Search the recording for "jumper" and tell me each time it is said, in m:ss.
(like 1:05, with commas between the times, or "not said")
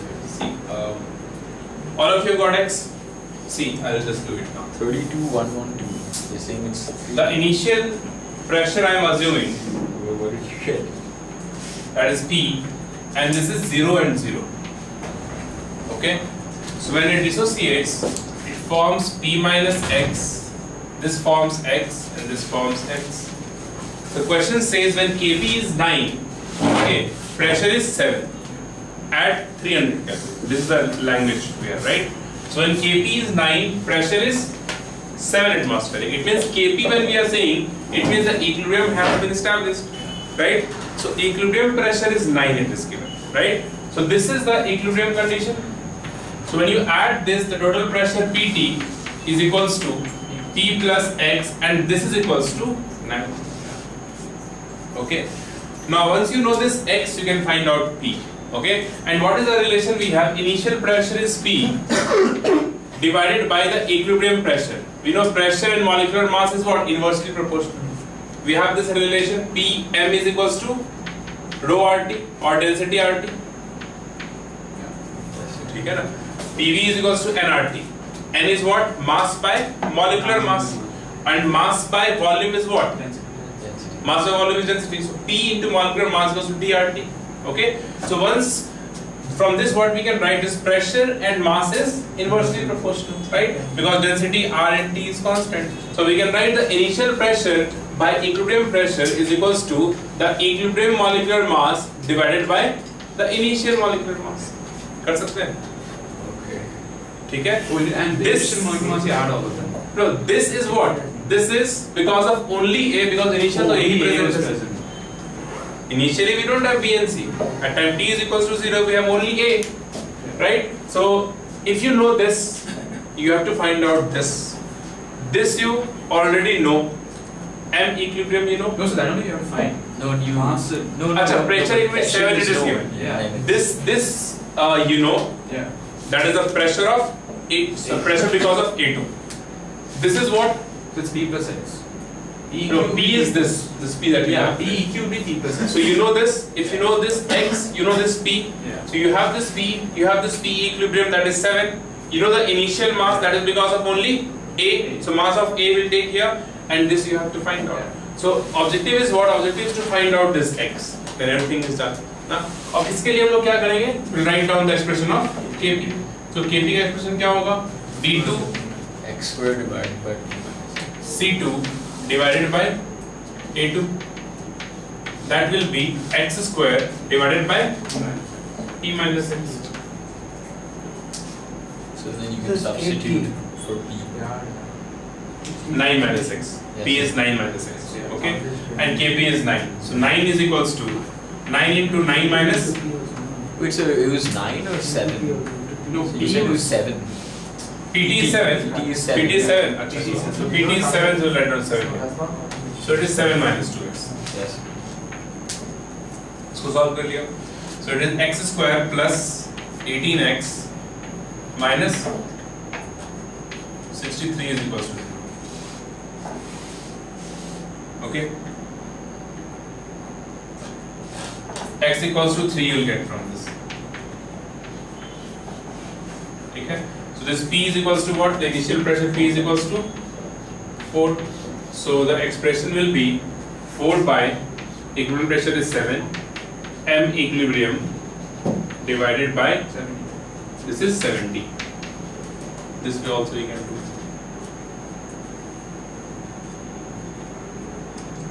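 not said.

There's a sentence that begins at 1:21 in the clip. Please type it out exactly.
And mass by volume is what?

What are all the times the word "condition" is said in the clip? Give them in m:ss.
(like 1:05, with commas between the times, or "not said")
0:45.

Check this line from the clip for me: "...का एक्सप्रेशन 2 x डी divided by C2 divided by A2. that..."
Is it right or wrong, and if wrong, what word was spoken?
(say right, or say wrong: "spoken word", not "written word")
right.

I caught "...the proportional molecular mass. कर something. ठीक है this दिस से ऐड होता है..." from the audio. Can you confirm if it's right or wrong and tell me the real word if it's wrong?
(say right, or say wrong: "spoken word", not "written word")
wrong: "initial", not "proportional".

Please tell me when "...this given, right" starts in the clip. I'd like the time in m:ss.
0:42.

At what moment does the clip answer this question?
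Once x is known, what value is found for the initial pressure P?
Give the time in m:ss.
3:49.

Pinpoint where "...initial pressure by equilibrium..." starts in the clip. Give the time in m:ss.
1:36.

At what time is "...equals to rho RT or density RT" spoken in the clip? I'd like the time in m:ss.
1:10.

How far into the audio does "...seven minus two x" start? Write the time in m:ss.
3:23.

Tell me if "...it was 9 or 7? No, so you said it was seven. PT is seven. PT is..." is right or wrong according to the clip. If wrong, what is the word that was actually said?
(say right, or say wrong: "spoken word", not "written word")
right.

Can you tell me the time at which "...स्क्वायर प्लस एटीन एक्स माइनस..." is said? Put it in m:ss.
3:28.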